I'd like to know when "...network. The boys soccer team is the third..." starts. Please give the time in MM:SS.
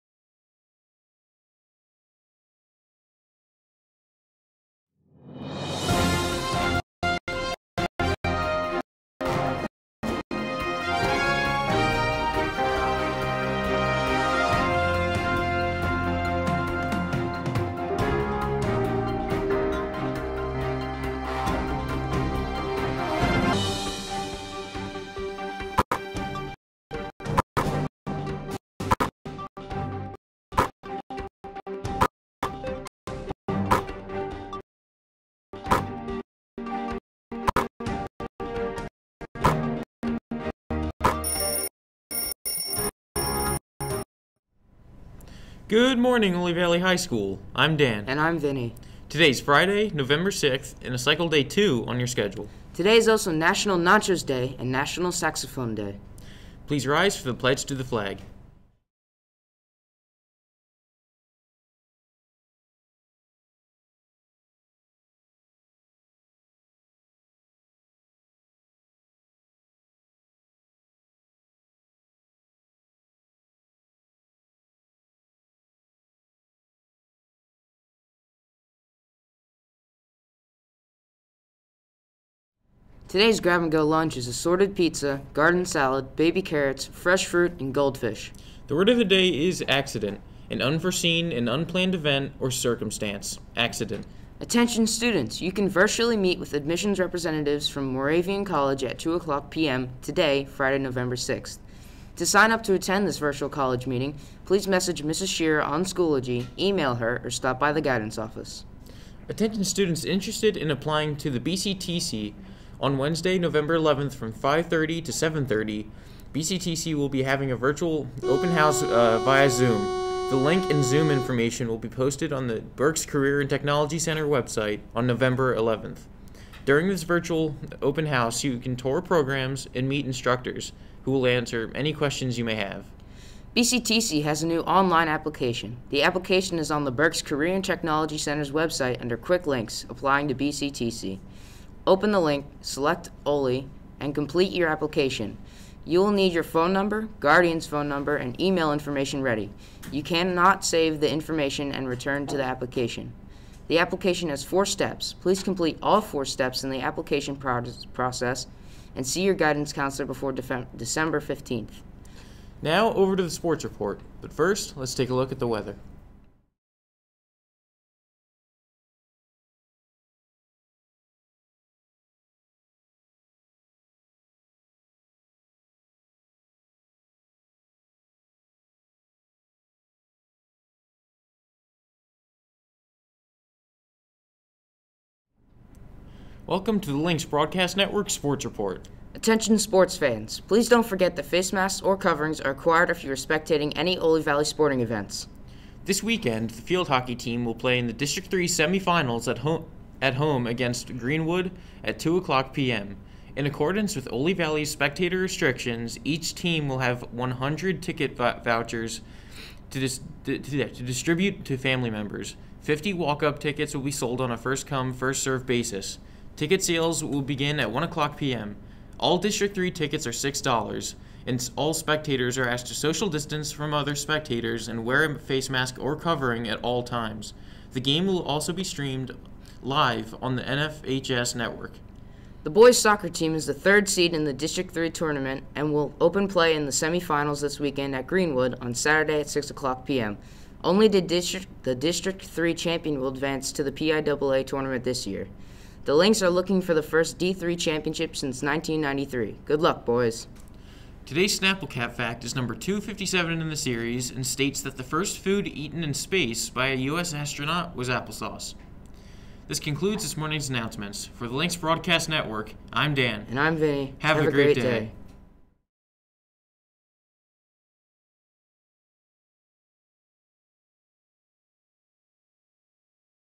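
03:51.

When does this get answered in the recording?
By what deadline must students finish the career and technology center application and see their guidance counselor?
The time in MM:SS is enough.
02:40.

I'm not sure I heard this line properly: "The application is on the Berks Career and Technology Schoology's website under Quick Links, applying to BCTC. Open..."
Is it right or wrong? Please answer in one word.
wrong.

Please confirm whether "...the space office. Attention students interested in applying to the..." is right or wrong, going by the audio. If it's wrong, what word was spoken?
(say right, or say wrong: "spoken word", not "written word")
wrong: "guidance", not "space".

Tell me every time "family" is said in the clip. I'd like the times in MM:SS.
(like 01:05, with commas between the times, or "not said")
03:31.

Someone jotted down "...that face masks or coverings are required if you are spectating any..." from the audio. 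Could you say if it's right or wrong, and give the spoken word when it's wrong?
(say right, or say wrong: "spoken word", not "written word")
right.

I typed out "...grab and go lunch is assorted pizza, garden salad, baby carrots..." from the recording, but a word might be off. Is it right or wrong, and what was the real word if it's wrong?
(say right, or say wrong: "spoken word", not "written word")
right.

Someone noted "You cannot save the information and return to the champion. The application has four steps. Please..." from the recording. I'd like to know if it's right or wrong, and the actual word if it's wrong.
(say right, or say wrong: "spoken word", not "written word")
wrong: "application", not "champion".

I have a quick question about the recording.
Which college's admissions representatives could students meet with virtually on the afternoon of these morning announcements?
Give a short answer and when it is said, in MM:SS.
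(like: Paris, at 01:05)
Moravian College, at 01:37.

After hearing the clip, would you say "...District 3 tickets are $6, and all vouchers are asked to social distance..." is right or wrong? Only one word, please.
wrong.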